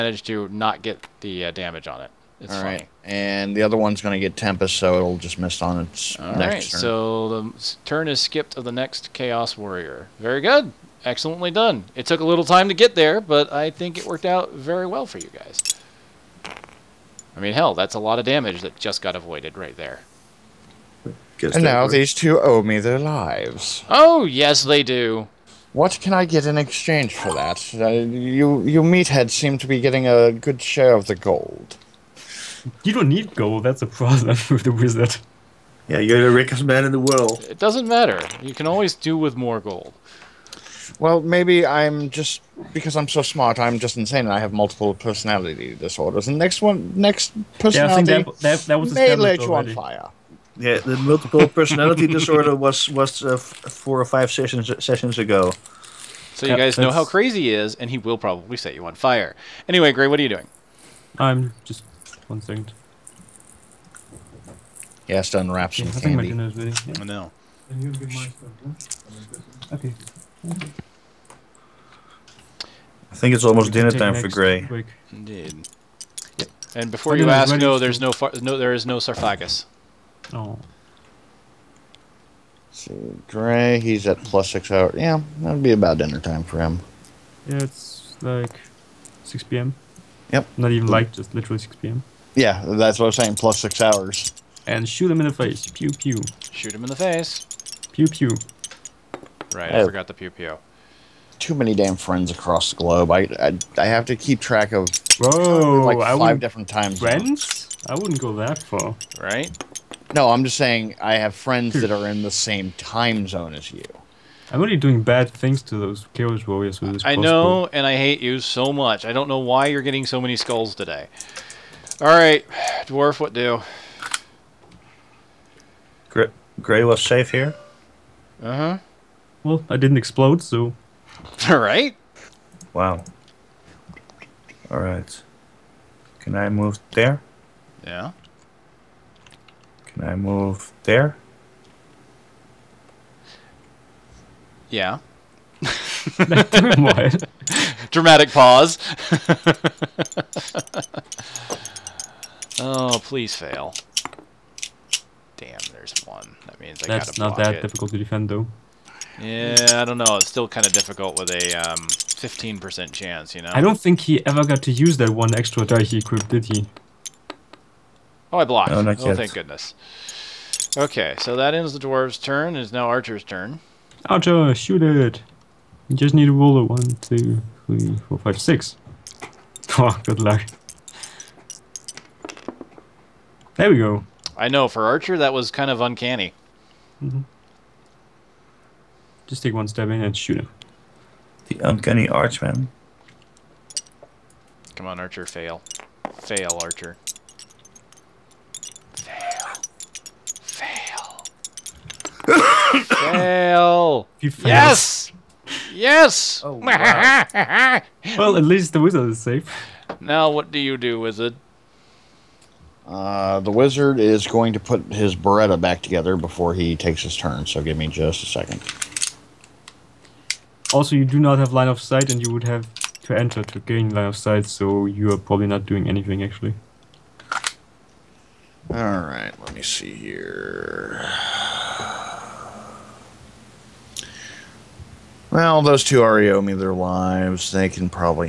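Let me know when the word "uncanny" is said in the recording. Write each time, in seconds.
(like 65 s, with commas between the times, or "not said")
185 s, 191 s.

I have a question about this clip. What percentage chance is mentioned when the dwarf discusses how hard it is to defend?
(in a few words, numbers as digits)
15%.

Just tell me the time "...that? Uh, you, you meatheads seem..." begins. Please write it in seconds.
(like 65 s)
27 s.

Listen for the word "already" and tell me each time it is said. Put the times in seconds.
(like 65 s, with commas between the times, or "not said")
114 s, 236 s.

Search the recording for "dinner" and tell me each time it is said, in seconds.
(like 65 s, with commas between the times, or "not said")
73 s, 85 s.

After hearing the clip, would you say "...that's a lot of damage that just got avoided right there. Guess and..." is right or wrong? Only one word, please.
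right.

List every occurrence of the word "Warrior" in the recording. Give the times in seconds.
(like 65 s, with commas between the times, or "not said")
9 s, 116 s.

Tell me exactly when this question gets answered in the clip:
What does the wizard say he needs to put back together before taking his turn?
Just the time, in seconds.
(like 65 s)
215 s.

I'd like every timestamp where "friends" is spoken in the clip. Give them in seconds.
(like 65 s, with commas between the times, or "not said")
101 s, 106 s, 111 s.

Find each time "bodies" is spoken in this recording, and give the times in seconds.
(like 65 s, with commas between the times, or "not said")
not said.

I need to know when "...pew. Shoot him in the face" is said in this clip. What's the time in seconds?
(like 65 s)
95 s.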